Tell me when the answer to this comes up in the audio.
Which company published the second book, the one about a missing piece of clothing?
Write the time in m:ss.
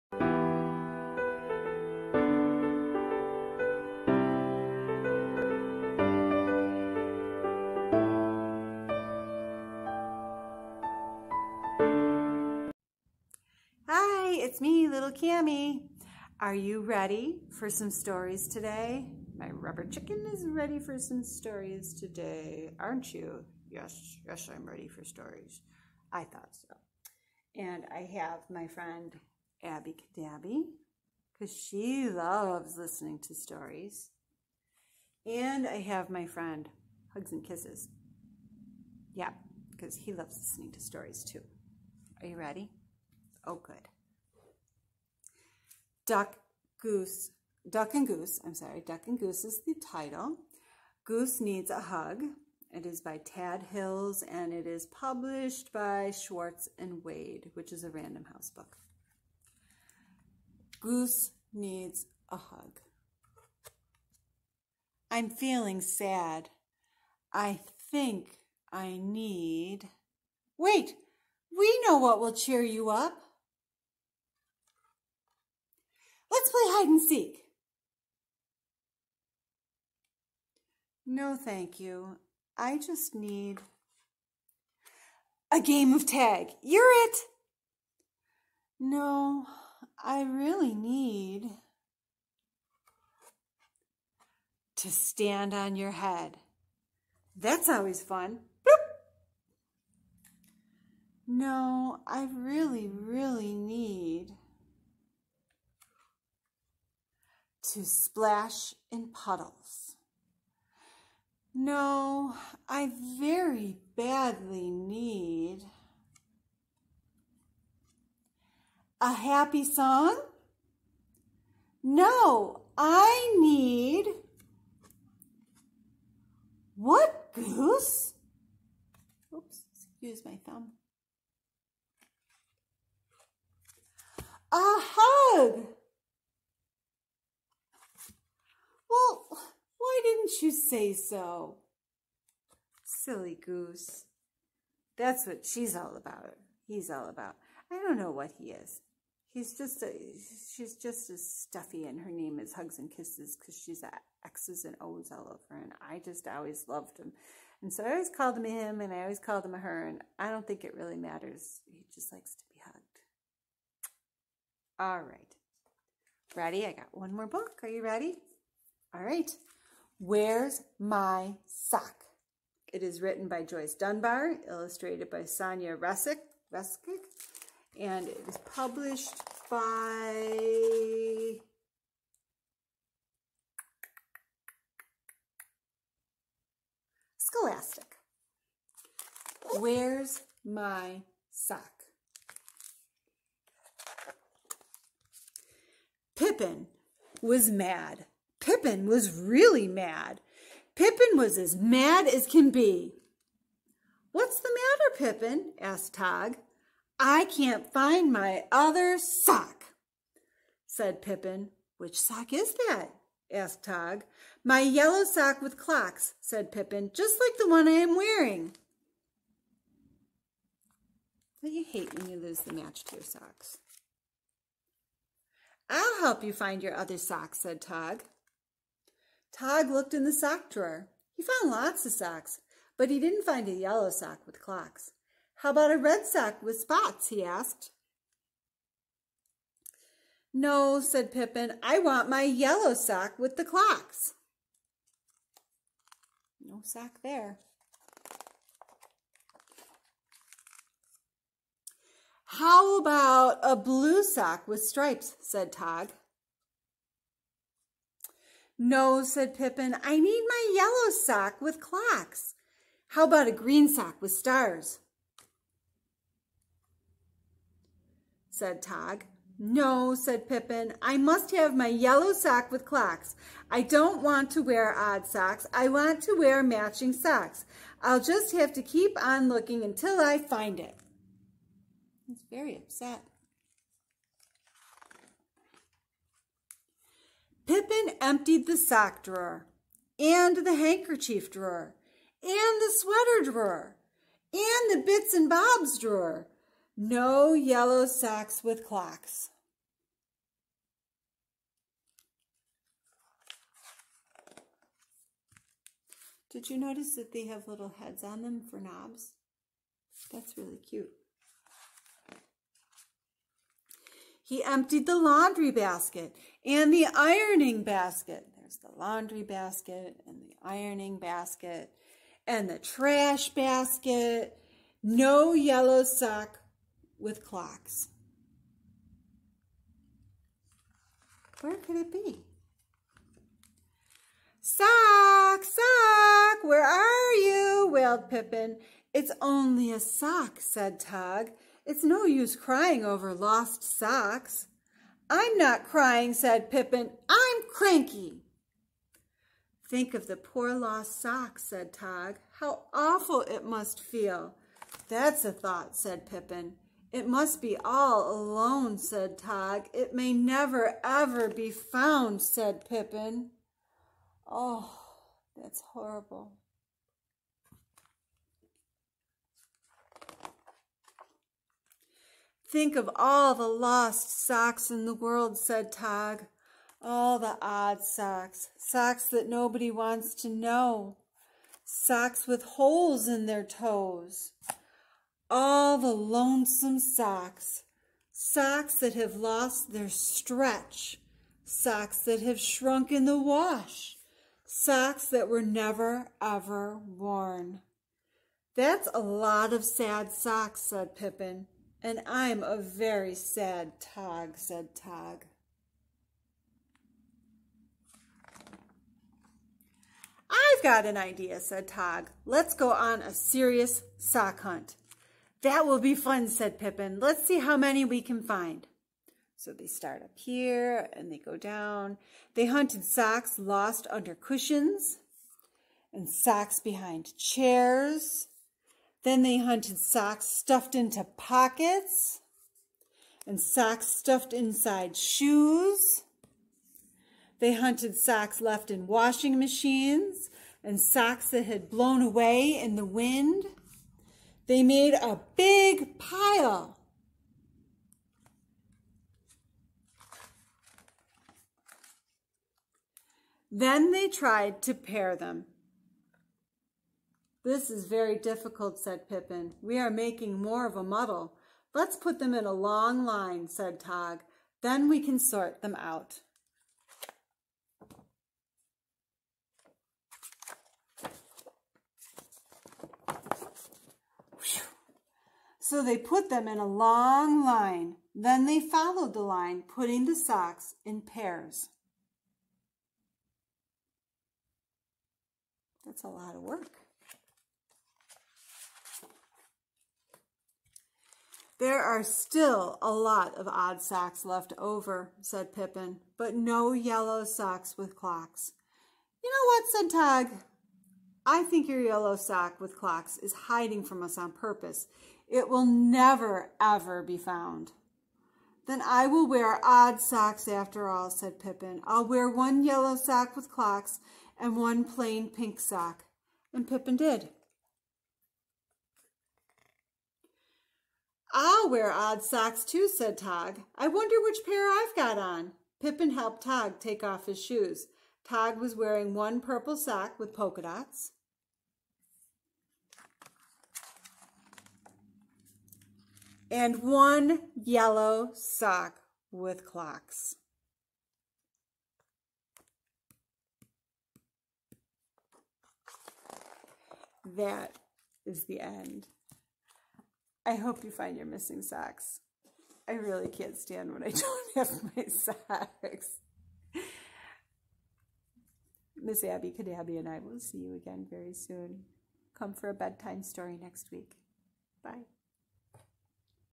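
3:07.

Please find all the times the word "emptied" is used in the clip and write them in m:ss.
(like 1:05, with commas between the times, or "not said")
4:47, 5:14.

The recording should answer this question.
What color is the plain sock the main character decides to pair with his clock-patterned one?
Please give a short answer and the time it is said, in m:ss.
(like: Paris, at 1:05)
Pink, at 8:35.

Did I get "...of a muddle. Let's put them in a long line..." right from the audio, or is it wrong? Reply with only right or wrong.
right.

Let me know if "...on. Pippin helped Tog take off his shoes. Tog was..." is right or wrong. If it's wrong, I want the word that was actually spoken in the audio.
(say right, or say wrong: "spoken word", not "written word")
right.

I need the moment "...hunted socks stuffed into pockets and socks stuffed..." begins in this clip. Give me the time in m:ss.
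7:09.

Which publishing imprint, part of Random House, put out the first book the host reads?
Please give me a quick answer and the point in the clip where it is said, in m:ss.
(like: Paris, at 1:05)
Schwartz and Wade, at 0:56.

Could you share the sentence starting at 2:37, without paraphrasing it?
And so I always called him him and I always called him her and I don't think it really matters.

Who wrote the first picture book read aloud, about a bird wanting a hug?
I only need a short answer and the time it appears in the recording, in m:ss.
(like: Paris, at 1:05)
Tad Hills, at 0:53.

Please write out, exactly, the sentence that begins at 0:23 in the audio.
Yes, yes, I'm ready for stories.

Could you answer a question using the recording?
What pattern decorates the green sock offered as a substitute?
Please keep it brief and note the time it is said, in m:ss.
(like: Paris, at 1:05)
Stars, at 4:24.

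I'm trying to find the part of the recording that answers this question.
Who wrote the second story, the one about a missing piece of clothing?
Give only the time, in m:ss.
2:53.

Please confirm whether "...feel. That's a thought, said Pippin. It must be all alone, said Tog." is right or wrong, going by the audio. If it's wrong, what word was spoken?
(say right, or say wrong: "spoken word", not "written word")
right.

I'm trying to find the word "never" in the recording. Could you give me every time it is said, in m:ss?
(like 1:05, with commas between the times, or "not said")
6:00, 6:35, 8:25.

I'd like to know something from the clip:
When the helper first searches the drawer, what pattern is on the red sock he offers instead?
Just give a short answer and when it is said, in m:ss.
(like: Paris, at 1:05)
Spots, at 3:56.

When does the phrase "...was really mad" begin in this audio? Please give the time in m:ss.
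3:18.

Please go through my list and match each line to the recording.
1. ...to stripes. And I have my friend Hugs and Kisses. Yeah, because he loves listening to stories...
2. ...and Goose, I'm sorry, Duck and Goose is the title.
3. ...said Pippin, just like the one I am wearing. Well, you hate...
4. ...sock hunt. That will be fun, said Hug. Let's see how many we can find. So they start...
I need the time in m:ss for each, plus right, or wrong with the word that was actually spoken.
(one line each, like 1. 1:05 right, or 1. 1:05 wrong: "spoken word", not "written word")
1. 0:33 wrong: "stories", not "stripes"
2. 0:47 right
3. 3:36 right
4. 6:53 wrong: "Pippin", not "Hug".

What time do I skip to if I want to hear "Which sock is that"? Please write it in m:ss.
3:31.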